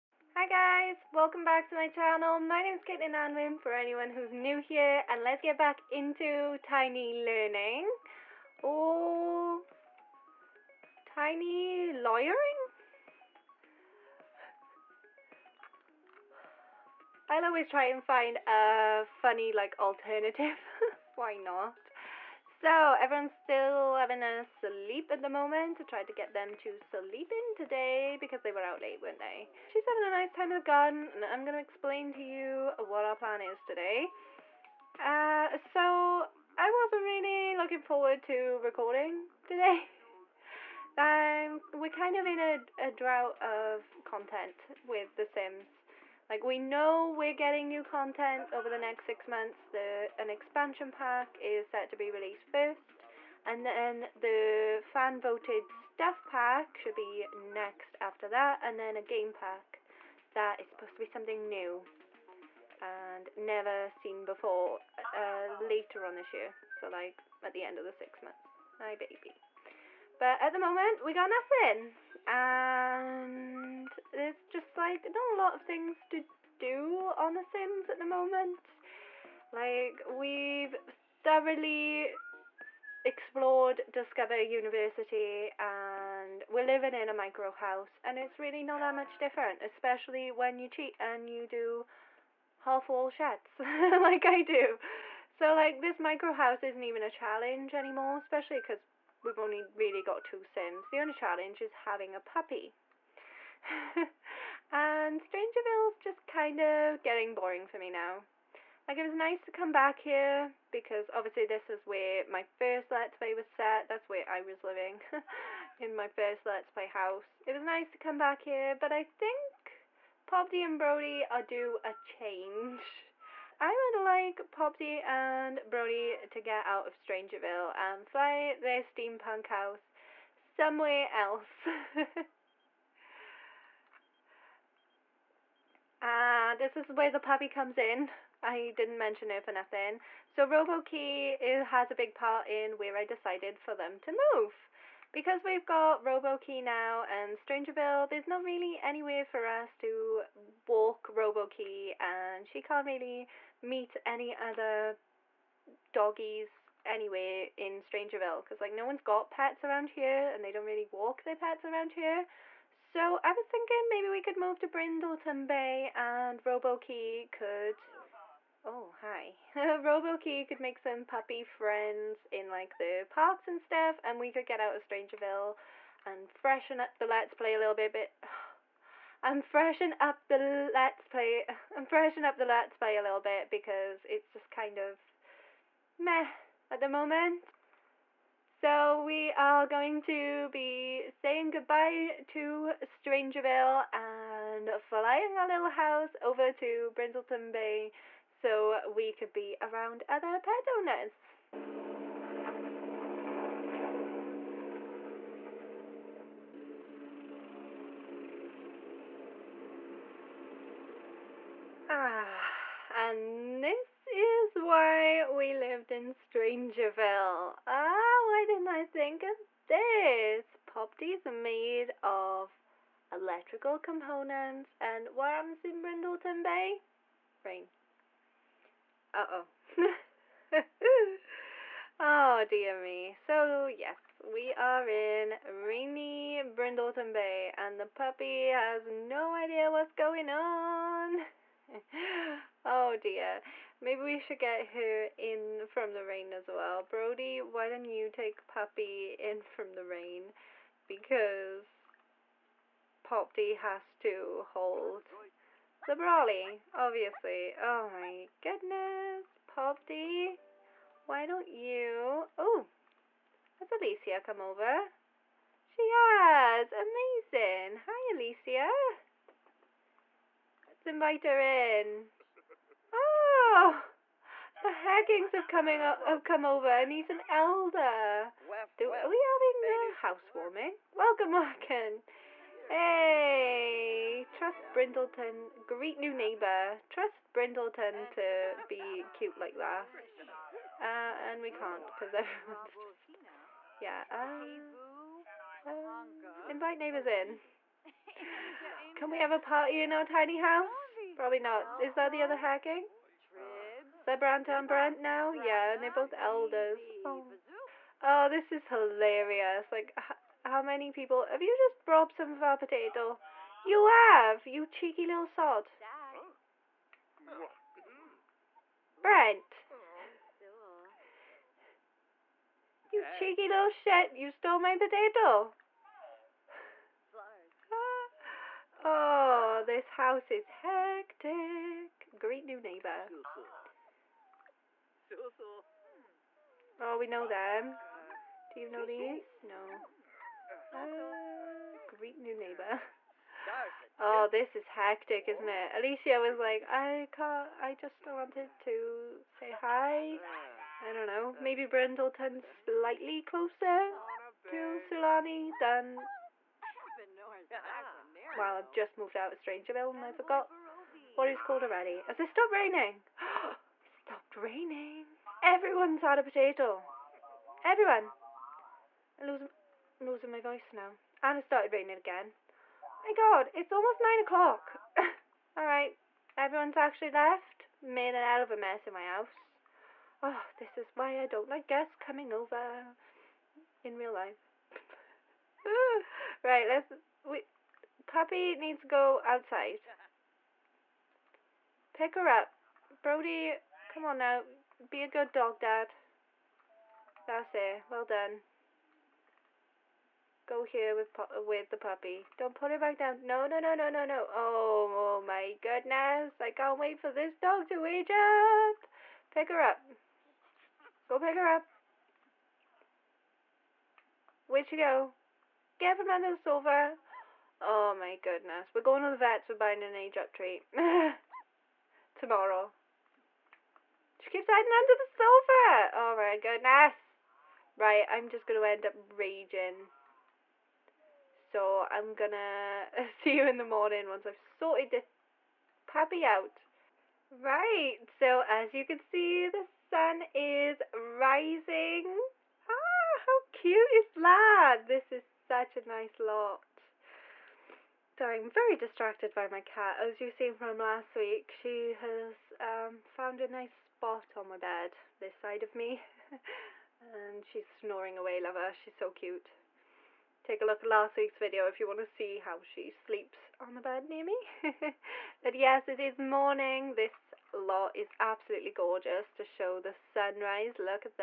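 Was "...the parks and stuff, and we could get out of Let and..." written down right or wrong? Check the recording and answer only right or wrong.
wrong.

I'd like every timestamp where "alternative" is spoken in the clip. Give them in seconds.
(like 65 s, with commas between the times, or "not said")
19 s.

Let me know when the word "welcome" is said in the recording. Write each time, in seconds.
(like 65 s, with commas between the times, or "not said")
1 s, 280 s.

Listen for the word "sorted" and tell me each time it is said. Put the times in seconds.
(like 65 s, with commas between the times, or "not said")
434 s.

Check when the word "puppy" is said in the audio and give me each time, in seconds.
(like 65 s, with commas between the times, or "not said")
102 s, 137 s, 171 s, 237 s, 248 s, 388 s, 401 s, 435 s.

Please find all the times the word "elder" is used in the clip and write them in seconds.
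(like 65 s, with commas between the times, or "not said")
277 s, 306 s.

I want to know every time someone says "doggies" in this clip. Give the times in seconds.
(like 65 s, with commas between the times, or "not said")
155 s.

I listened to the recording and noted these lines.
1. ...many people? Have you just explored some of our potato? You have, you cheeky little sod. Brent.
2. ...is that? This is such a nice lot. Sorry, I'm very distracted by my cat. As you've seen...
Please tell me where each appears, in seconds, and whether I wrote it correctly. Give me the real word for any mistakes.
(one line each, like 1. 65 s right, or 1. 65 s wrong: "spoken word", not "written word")
1. 310 s wrong: "robbed", not "explored"
2. 443 s right.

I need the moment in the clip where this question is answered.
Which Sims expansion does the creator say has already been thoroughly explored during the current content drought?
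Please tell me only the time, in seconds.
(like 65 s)
83 s.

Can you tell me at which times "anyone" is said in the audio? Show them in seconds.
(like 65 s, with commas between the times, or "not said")
3 s.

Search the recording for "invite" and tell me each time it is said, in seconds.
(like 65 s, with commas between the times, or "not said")
270 s, 296 s.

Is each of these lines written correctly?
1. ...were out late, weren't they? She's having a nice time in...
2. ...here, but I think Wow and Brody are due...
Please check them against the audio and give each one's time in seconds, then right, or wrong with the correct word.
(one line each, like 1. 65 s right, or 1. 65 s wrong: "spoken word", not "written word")
1. 28 s right
2. 118 s wrong: "Popty", not "Wow".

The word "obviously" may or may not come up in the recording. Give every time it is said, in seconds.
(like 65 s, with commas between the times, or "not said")
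111 s, 256 s.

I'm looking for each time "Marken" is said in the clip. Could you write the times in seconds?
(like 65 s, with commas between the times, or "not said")
281 s.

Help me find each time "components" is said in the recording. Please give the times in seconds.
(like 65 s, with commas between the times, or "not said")
223 s.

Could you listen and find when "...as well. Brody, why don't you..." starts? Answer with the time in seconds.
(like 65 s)
246 s.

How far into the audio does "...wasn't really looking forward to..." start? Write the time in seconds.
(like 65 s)
36 s.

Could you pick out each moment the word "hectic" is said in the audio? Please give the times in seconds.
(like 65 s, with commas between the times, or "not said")
330 s, 344 s.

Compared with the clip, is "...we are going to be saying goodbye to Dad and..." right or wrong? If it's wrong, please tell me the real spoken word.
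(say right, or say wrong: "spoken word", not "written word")
wrong: "Strangerville", not "Dad".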